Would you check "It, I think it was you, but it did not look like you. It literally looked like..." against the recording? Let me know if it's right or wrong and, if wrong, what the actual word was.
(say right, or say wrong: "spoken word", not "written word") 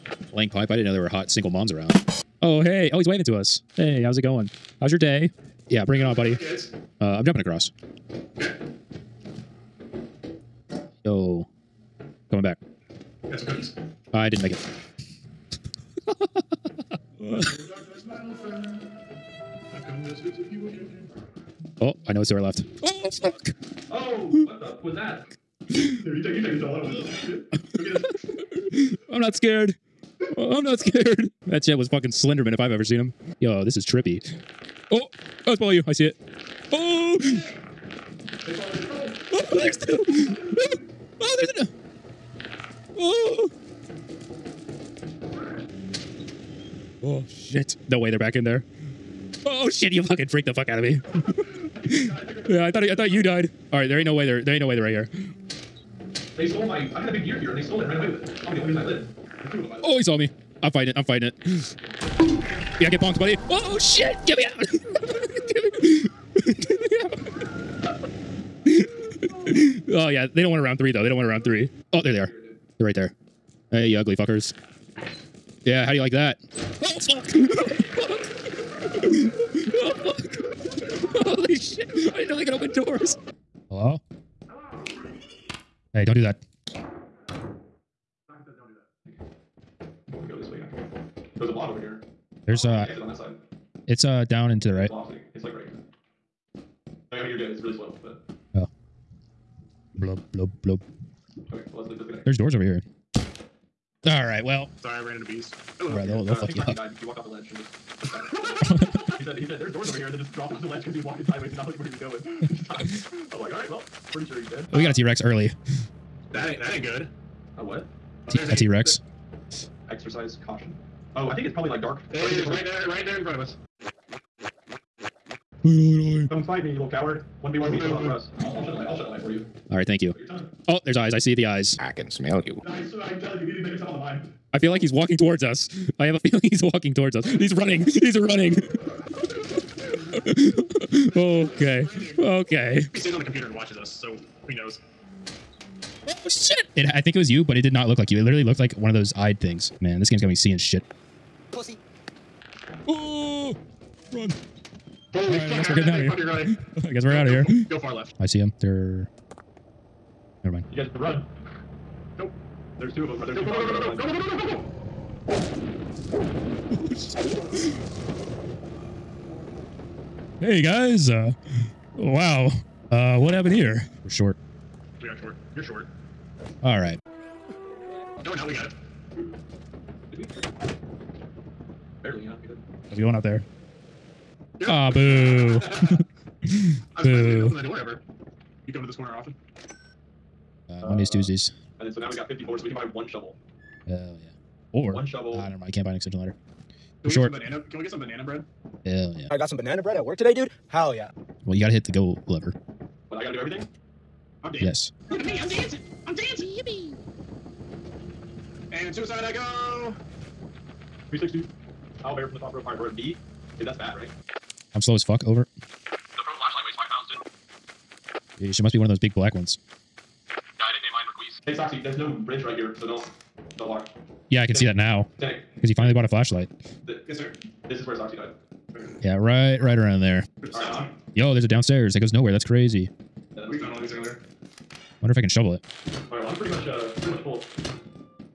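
right.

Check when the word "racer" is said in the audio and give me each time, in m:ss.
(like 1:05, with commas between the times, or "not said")
not said.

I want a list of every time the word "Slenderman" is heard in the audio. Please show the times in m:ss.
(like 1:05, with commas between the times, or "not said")
0:32.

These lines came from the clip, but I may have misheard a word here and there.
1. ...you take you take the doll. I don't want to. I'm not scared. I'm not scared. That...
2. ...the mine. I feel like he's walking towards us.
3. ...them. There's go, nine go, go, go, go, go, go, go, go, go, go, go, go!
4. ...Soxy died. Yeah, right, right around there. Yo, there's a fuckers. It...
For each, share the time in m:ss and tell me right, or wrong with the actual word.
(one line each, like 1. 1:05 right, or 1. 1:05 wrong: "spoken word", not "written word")
1. 0:26 right
2. 2:13 right
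3. 2:43 wrong: "two", not "nine"
4. 3:47 wrong: "downstairs", not "fuckers".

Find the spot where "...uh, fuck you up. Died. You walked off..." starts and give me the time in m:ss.
1:46.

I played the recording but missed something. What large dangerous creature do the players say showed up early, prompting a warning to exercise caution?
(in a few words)
T Rex.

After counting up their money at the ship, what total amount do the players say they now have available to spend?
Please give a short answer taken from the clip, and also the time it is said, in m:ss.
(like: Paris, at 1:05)
54, at 3:12.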